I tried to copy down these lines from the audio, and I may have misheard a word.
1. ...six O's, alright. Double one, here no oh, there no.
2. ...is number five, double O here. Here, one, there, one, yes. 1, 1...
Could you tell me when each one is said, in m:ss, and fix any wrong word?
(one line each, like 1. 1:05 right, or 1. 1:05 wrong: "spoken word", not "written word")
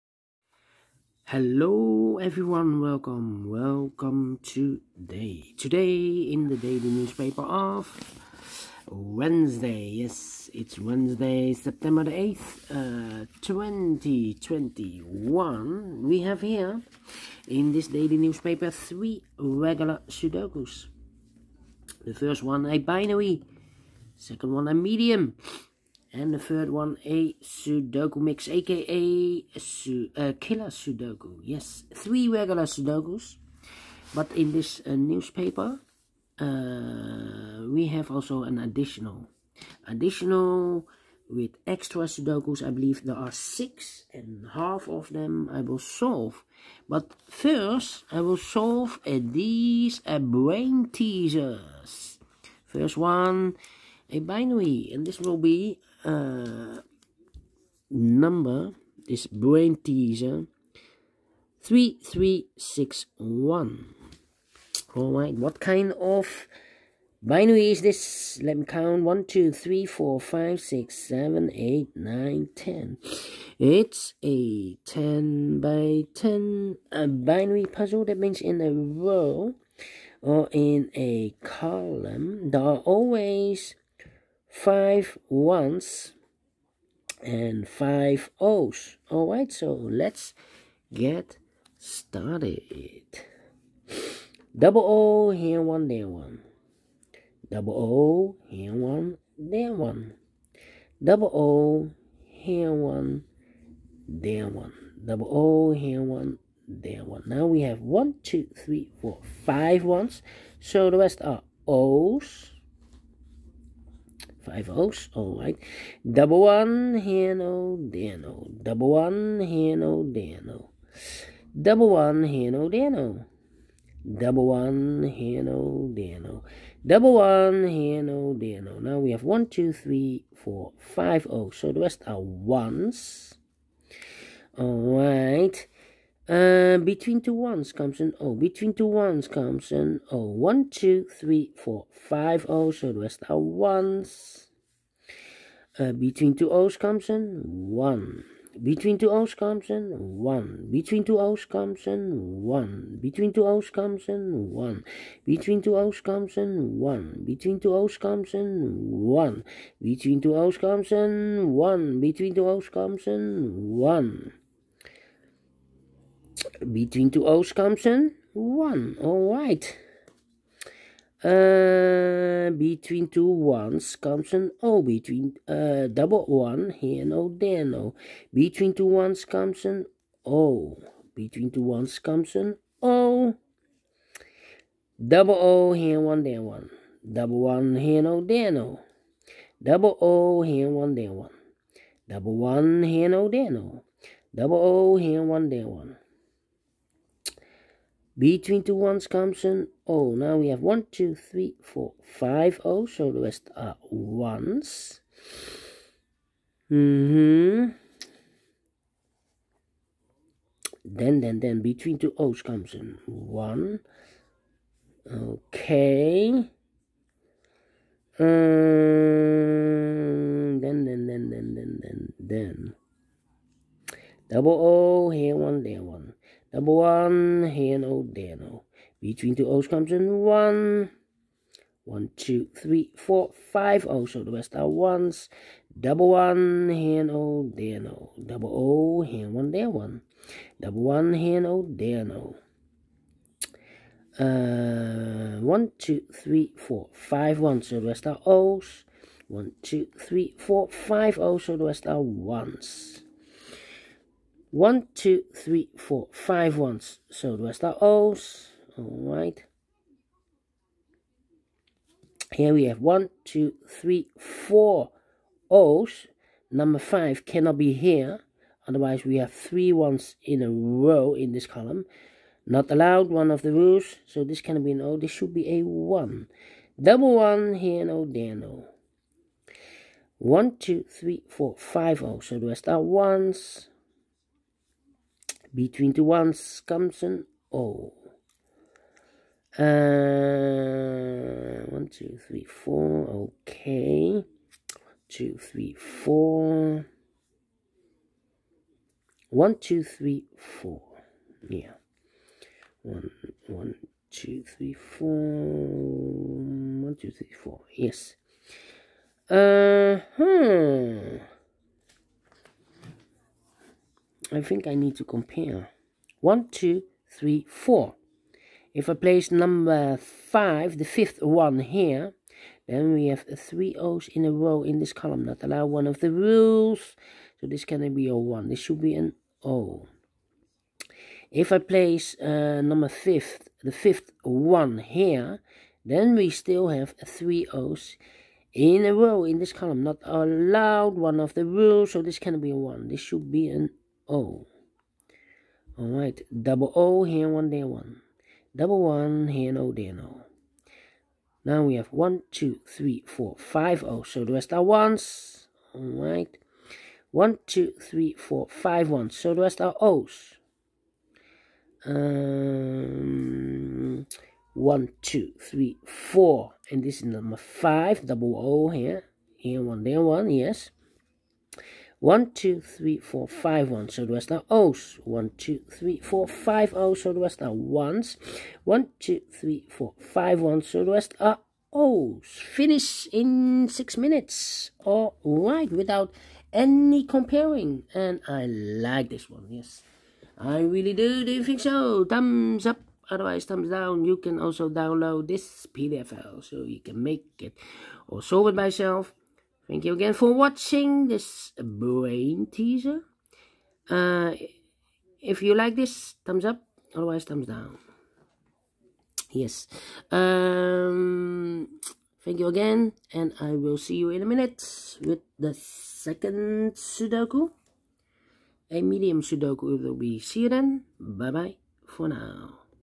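1. 1:54 wrong: "five", not "six"
2. 6:06 wrong: "2", not "1".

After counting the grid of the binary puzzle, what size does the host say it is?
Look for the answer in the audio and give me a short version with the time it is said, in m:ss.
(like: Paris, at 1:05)
10 by 10, at 1:14.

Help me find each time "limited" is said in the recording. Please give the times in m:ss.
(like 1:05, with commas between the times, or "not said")
not said.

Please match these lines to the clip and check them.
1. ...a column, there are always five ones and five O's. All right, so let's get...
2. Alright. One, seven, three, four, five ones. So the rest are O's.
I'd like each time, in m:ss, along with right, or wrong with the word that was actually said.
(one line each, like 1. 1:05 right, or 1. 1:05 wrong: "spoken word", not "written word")
1. 1:20 right
2. 5:55 wrong: "two", not "seven".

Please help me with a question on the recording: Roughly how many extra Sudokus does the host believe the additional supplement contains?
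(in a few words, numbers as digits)
6.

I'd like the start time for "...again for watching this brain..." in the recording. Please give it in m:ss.
6:39.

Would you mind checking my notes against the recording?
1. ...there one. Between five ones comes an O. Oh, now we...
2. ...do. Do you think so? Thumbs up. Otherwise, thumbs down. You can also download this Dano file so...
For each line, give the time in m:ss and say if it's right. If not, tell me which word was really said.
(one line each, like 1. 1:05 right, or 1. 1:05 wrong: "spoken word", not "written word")
1. 3:15 wrong: "two", not "five"
2. 6:30 wrong: "PDF", not "Dano".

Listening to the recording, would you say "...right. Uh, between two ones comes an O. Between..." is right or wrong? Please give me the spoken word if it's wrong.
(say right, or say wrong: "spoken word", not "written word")
right.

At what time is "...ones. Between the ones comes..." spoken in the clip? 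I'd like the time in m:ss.
4:42.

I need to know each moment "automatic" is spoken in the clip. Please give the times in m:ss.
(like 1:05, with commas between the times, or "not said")
not said.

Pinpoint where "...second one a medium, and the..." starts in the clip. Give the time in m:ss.
0:24.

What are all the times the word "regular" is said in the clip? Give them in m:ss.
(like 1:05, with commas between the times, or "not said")
0:19, 0:32.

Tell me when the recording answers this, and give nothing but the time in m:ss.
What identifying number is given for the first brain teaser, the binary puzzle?
1:01.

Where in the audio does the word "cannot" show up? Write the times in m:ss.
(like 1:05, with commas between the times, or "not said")
4:27, 4:34, 5:27, 5:42.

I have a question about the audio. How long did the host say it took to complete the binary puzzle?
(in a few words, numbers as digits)
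6 minutes.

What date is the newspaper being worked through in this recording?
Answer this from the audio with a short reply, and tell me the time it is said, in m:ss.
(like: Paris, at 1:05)
September 8, 2021, at 0:11.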